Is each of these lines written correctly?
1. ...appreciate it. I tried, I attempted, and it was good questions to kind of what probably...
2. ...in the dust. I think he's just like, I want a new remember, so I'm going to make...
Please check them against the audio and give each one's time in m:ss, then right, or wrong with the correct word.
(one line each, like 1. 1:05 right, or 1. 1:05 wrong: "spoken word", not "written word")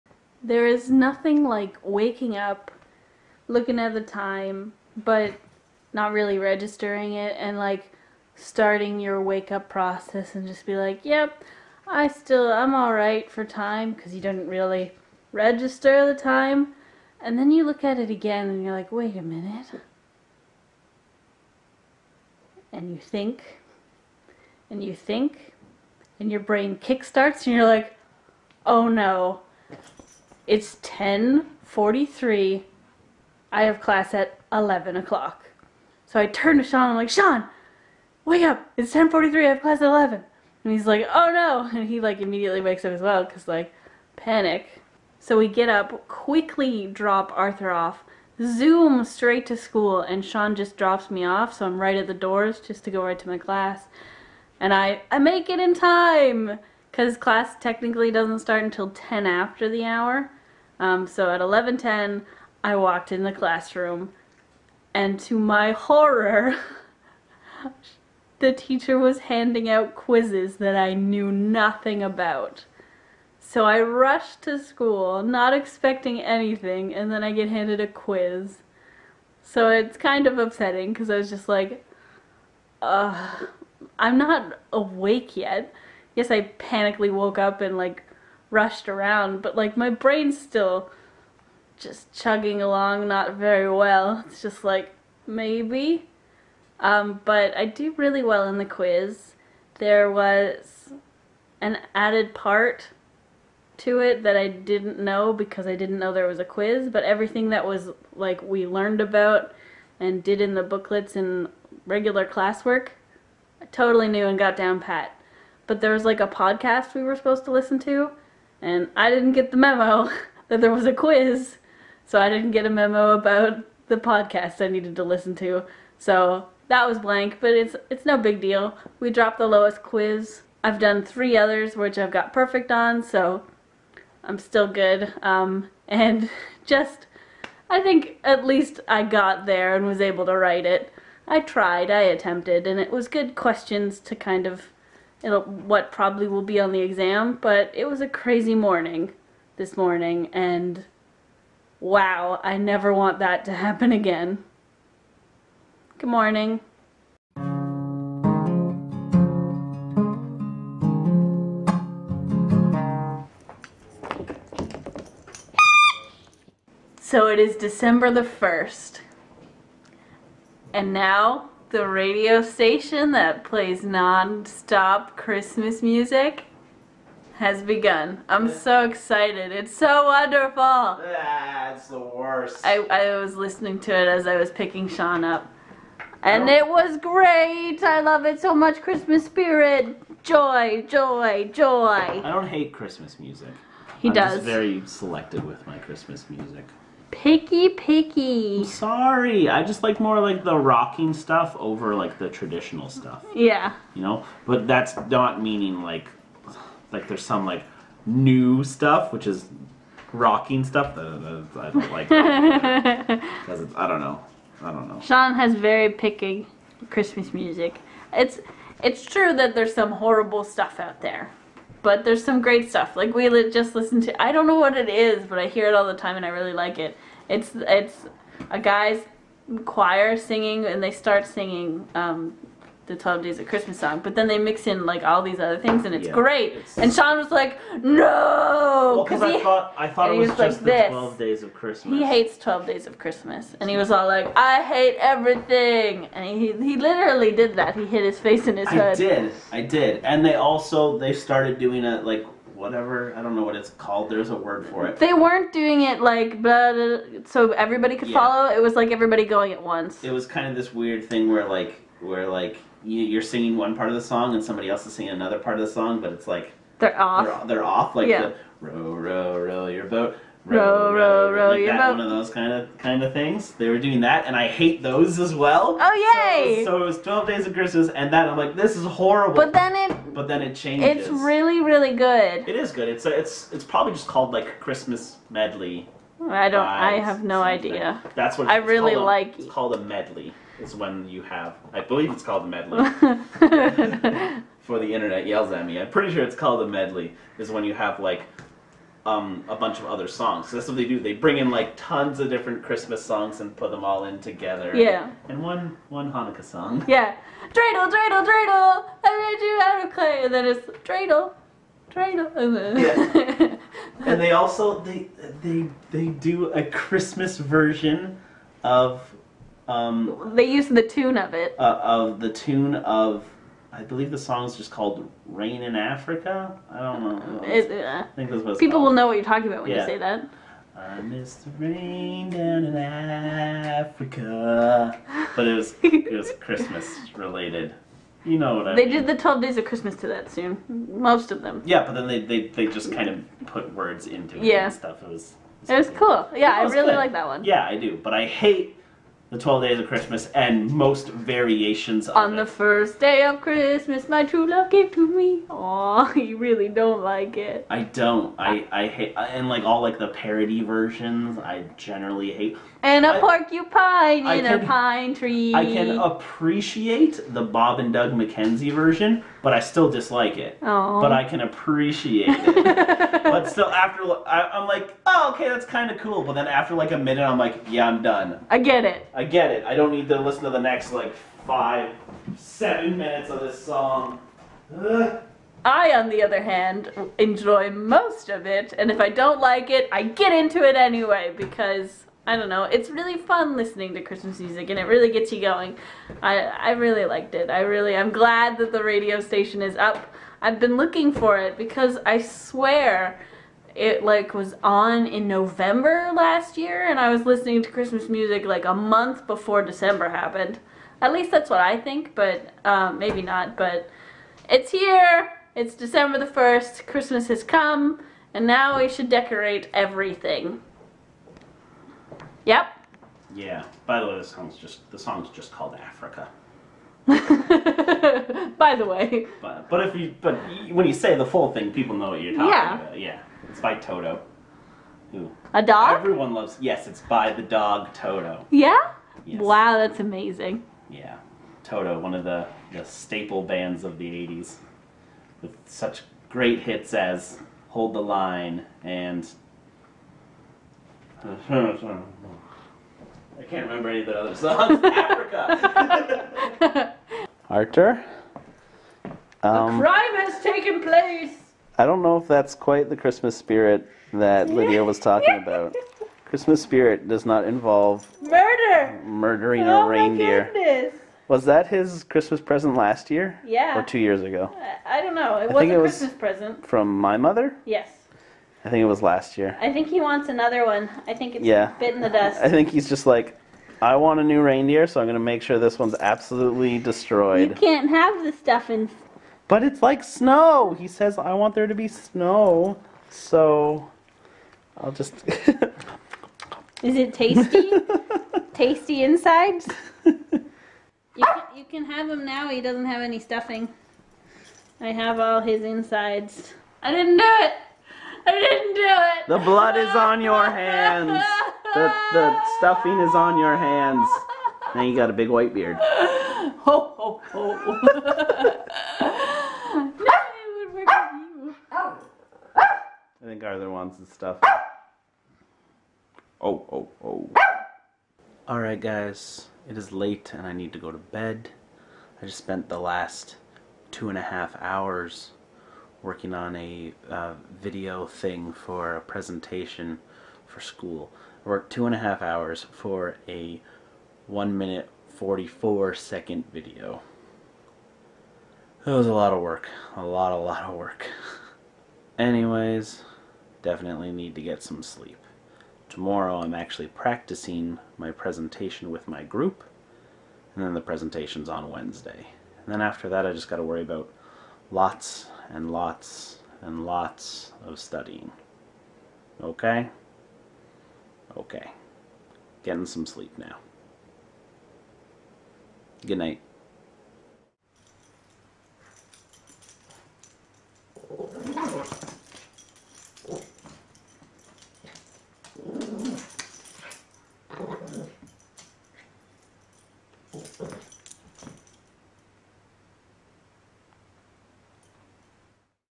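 1. 2:20 wrong: "write", not "appreciate"
2. 8:01 wrong: "reindeer", not "remember".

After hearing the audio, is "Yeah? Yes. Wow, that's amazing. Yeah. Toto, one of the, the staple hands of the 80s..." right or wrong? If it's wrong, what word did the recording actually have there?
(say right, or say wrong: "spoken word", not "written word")
wrong: "bands", not "hands".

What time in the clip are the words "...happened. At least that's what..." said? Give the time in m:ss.
6:50.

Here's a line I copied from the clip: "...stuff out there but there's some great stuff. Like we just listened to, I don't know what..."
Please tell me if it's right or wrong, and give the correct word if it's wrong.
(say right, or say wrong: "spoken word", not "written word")
right.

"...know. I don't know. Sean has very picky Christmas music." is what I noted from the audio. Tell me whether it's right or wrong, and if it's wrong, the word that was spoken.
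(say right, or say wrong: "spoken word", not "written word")
right.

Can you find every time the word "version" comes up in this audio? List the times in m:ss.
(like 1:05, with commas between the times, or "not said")
5:17, 6:00, 6:08.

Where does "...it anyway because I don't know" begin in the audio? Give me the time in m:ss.
6:30.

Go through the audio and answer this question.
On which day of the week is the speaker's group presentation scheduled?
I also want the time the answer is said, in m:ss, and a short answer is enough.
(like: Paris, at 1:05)
Wednesday, at 9:21.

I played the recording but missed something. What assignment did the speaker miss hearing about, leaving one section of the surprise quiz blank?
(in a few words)
a podcast.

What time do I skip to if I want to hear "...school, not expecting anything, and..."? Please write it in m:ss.
1:14.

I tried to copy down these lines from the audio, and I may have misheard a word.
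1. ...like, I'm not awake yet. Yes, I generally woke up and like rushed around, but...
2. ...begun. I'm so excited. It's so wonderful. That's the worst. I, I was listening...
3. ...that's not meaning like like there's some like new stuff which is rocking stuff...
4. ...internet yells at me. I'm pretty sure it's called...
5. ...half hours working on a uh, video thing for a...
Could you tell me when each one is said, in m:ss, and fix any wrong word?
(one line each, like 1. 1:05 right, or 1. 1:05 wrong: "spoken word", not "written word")
1. 1:21 wrong: "panically", not "generally"
2. 2:57 right
3. 3:24 right
4. 4:54 right
5. 8:54 right.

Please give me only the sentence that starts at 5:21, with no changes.
Uh, of the tune of, I believe the song is just called "Rain in Africa." I don't know.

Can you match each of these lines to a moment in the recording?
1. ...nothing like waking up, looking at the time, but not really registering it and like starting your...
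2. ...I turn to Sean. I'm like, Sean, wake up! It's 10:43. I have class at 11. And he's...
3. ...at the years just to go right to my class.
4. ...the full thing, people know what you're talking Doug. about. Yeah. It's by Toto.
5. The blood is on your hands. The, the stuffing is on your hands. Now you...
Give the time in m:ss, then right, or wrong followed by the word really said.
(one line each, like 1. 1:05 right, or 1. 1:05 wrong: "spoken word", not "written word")
1. 0:00 right
2. 0:36 right
3. 0:51 wrong: "doors", not "years"
4. 7:11 wrong: "Yeah", not "Doug"
5. 8:29 right.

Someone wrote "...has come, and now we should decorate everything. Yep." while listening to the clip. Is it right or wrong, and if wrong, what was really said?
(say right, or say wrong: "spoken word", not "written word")
right.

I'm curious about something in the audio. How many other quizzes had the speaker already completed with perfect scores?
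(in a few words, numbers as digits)
3.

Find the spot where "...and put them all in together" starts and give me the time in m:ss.
5:03.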